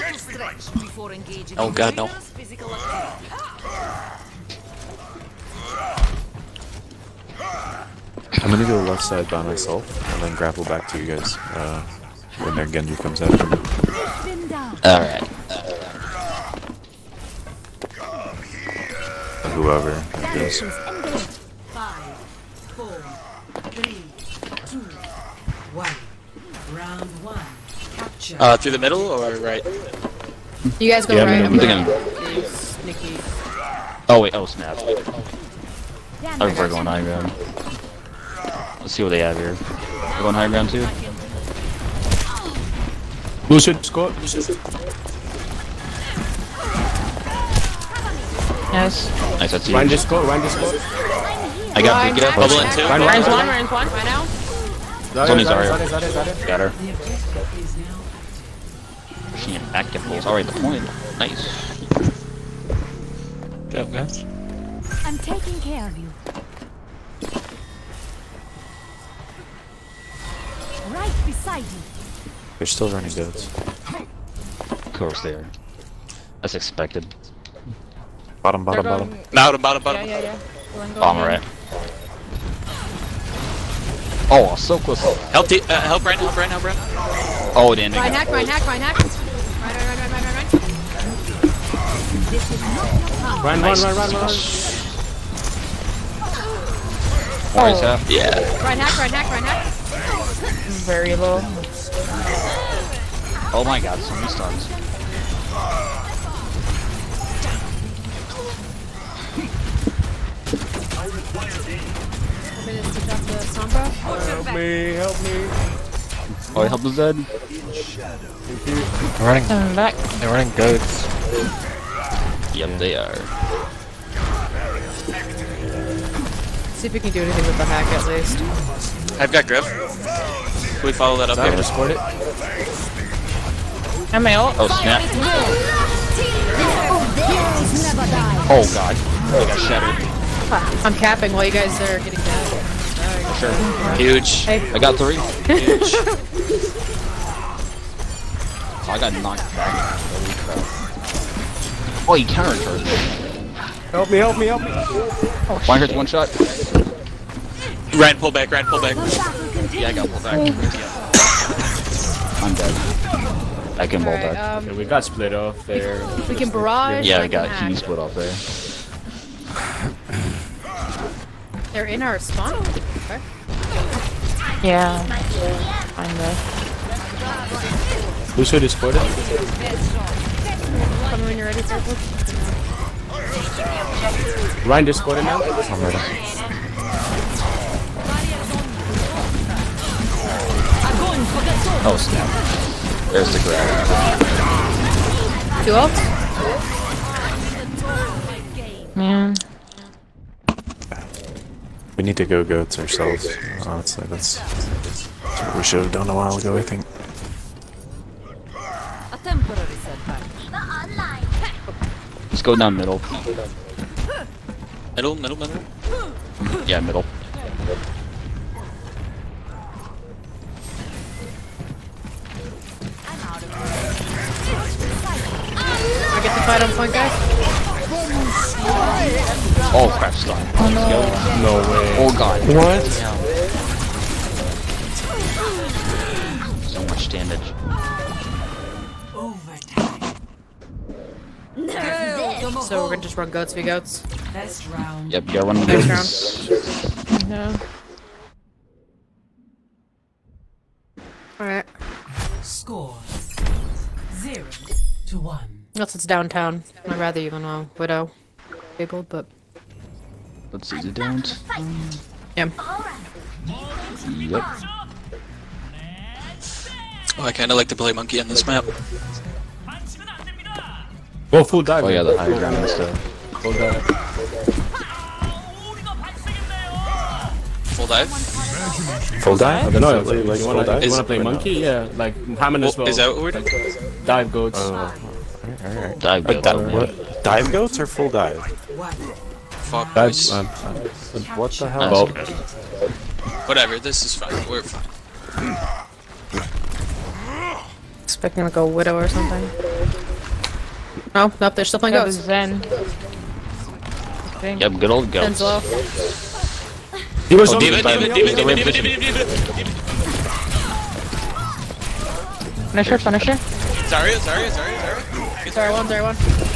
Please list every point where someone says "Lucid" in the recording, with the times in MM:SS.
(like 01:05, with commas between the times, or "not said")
00:43.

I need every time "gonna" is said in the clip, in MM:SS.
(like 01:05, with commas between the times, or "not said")
00:08, 04:02.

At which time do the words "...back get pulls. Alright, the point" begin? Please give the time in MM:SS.
00:59.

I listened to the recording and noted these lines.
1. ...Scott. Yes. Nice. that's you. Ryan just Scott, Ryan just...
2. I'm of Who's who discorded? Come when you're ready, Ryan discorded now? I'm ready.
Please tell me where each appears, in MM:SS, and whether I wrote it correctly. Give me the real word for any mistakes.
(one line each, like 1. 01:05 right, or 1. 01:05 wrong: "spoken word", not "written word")
1. 00:43 right
2. 02:55 right.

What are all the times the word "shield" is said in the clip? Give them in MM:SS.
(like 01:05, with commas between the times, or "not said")
not said.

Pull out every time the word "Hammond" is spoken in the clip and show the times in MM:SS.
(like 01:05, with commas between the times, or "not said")
04:42.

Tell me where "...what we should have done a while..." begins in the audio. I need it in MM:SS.
03:25.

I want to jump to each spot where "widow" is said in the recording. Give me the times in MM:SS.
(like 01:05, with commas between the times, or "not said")
04:17, 04:58.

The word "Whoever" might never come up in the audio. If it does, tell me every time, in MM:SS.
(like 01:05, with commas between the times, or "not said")
00:19.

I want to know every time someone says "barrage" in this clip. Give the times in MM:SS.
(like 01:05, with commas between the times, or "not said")
02:46.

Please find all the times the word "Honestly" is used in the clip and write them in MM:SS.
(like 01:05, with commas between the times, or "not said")
03:23.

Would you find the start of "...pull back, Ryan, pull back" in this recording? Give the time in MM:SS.
02:38.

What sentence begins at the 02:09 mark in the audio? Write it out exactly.
Can we follow that up here?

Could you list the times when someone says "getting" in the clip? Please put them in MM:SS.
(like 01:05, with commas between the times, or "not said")
02:21.